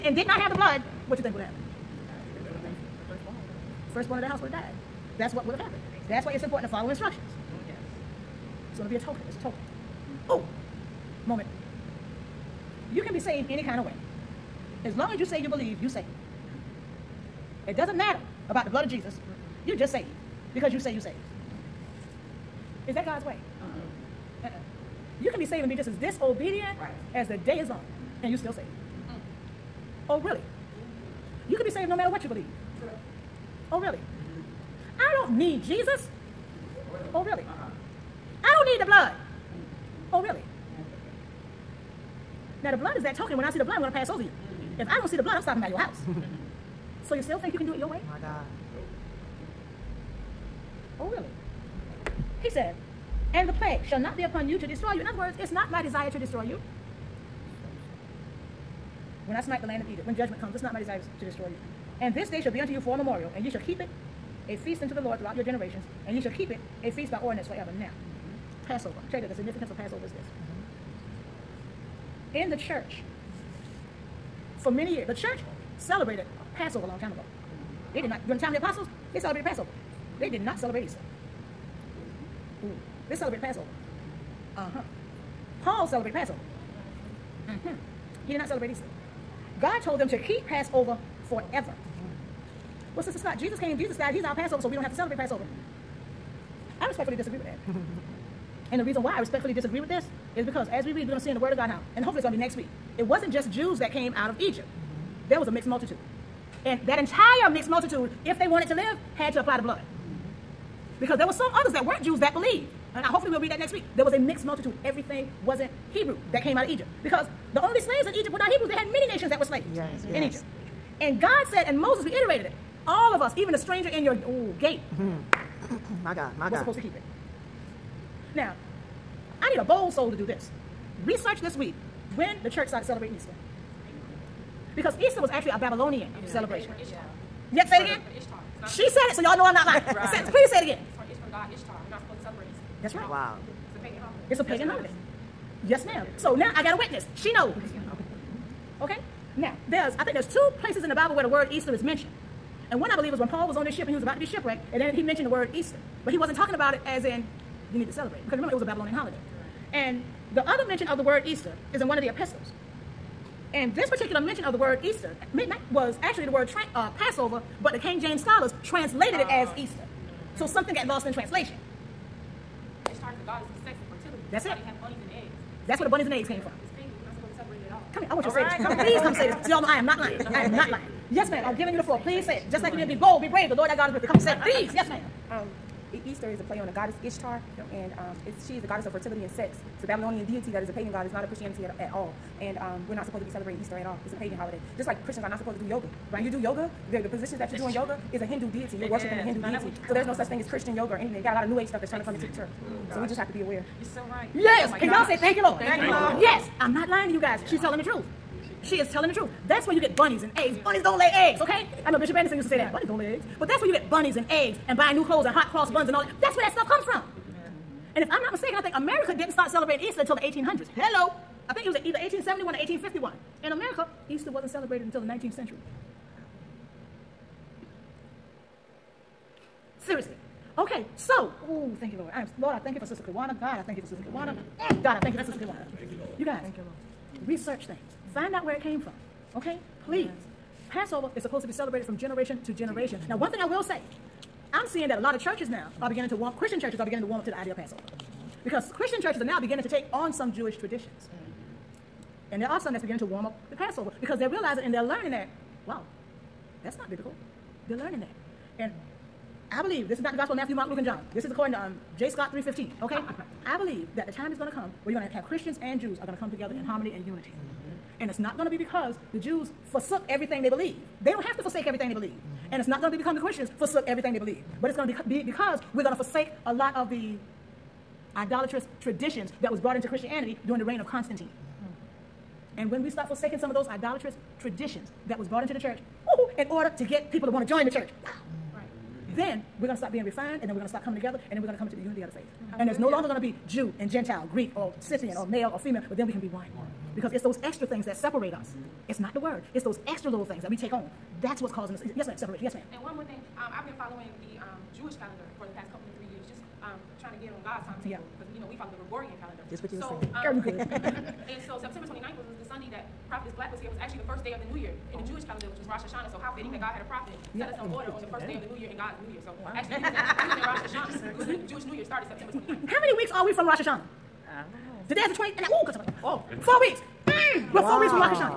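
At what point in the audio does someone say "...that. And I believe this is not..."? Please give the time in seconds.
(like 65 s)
257 s.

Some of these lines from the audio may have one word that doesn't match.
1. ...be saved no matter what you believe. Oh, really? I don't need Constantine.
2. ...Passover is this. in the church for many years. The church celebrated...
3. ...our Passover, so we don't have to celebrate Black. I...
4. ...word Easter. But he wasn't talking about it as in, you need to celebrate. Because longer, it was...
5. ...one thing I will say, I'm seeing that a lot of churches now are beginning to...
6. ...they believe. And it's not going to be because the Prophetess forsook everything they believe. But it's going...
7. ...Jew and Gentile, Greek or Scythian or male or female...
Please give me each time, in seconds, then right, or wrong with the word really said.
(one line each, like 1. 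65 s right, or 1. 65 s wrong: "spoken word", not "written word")
1. 31 s wrong: "Jesus", not "Constantine"
2. 69 s right
3. 94 s wrong: "Passover", not "Black"
4. 155 s wrong: "remember", not "longer"
5. 243 s right
6. 271 s wrong: "Christians", not "Prophetess"
7. 293 s right.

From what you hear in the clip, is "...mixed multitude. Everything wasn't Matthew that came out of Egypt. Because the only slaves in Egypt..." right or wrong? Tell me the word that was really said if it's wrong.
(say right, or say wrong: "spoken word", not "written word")
wrong: "Hebrew", not "Matthew".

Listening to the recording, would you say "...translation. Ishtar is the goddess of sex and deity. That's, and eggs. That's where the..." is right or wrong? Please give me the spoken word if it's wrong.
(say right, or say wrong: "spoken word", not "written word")
wrong: "fertility", not "deity".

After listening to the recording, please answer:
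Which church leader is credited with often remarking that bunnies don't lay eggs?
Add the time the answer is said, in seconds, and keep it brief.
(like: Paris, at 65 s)
Bishop Anderson, at 212 s.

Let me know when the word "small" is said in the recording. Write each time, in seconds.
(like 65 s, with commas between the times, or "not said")
not said.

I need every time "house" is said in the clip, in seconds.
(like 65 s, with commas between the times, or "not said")
4 s, 45 s.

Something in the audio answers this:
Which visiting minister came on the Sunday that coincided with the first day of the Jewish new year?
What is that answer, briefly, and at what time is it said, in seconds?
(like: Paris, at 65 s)
Prophetess Black, at 313 s.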